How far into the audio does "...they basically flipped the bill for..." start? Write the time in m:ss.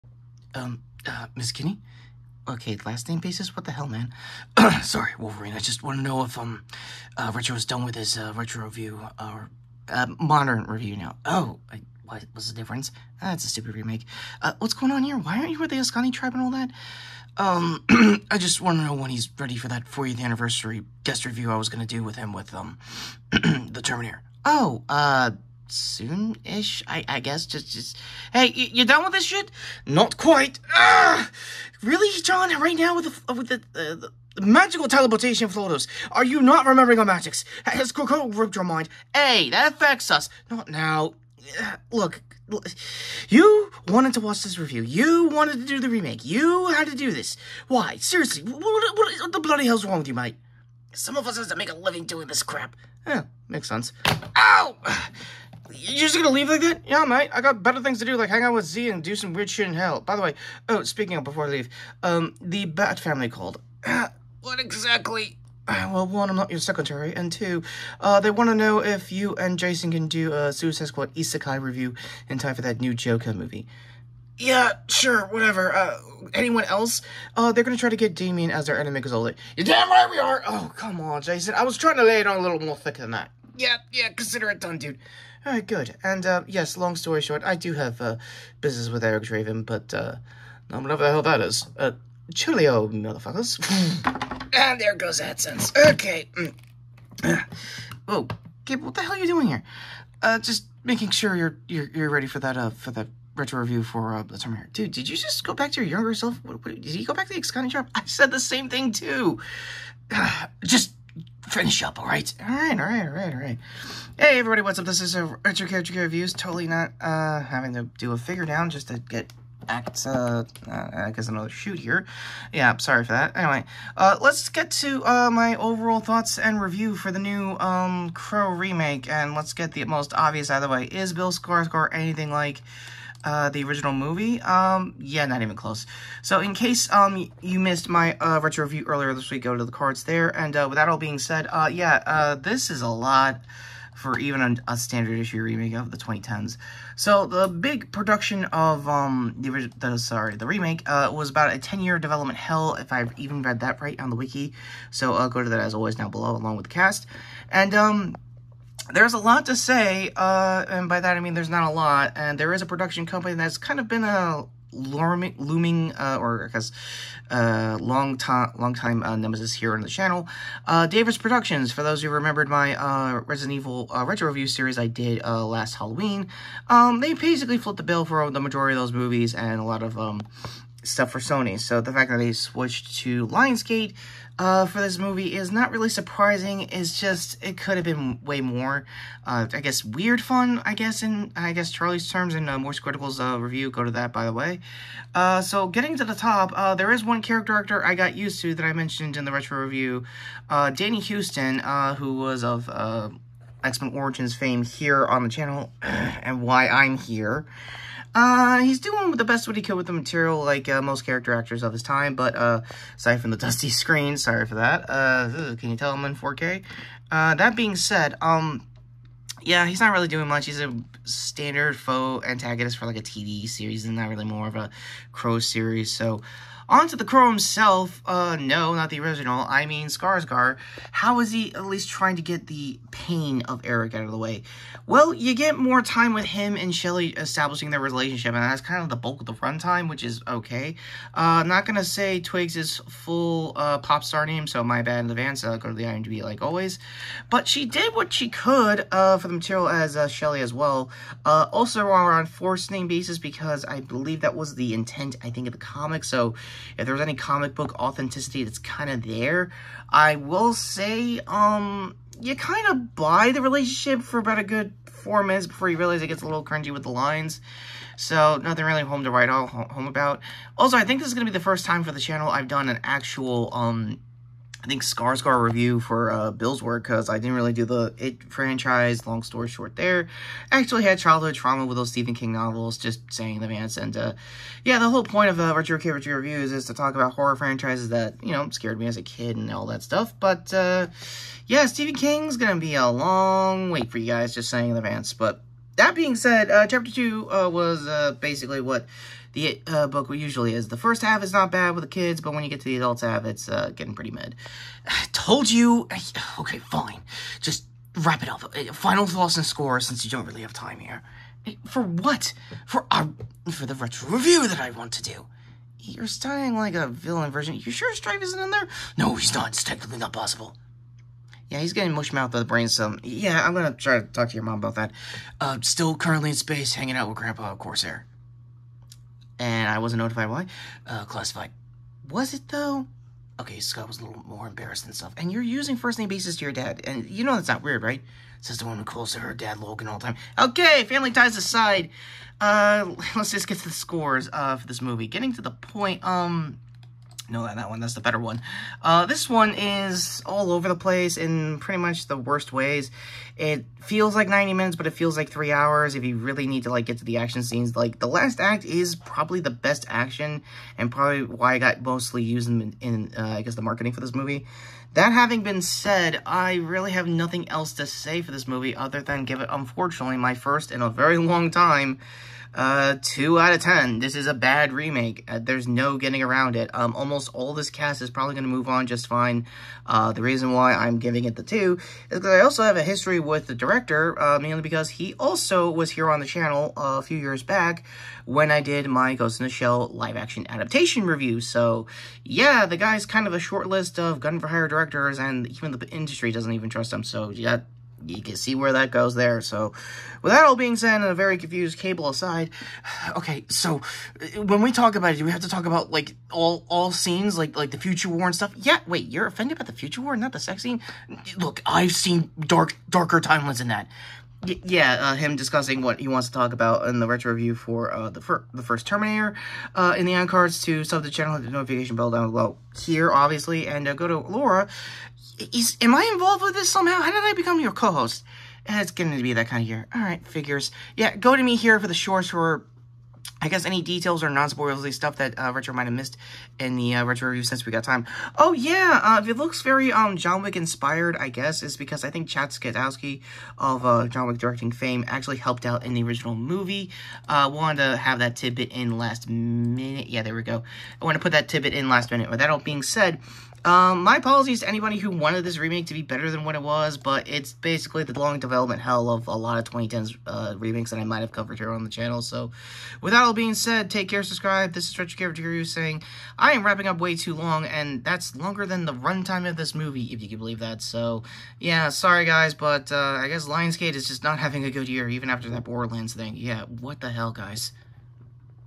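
2:56.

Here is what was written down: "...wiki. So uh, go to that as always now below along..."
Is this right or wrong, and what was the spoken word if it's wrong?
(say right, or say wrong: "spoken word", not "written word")
right.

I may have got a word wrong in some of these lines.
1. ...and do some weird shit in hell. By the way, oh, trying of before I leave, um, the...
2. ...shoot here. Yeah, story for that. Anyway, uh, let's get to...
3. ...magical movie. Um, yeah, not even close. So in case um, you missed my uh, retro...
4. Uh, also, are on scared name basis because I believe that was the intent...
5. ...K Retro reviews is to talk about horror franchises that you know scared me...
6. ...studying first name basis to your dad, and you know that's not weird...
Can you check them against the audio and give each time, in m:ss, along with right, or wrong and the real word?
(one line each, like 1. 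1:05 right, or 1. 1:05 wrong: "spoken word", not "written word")
1. 0:58 wrong: "speaking", not "trying"
2. 2:01 wrong: "sorry", not "story"
3. 2:13 wrong: "original", not "magical"
4. 4:11 wrong: "forced", not "scared"
5. 4:45 right
6. 5:35 wrong: "using", not "studying".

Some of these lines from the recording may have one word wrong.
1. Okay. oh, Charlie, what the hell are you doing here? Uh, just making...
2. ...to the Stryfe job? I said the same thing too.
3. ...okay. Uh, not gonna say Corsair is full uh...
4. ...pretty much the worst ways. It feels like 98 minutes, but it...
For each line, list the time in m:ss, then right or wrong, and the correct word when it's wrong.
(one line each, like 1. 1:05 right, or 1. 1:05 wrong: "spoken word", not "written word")
1. 1:35 wrong: "Gabe", not "Charlie"
2. 1:47 wrong: "Askani", not "Stryfe"
3. 4:00 wrong: "Twigs", not "Corsair"
4. 5:51 wrong: "90", not "98".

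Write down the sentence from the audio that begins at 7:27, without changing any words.
Uh, wanted to have that tidbit in last minute.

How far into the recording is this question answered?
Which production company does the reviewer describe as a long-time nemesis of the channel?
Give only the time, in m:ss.
2:50.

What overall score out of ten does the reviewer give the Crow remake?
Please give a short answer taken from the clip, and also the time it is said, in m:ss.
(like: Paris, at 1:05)
2 out of 10, at 6:13.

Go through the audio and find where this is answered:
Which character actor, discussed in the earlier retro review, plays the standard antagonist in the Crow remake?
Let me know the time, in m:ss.
3:20.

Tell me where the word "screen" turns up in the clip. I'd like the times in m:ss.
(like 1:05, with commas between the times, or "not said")
3:33.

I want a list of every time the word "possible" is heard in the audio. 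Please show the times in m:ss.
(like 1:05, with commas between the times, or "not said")
5:20.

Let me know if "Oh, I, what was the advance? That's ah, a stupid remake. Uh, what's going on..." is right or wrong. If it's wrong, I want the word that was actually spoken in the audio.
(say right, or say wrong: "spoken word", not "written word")
wrong: "difference", not "advance".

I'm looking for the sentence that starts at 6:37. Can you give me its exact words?
So, yeah, you can see where that goes there.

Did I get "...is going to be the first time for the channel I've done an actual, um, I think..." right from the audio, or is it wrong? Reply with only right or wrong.
right.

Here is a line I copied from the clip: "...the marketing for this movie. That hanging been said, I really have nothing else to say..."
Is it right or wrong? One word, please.
wrong.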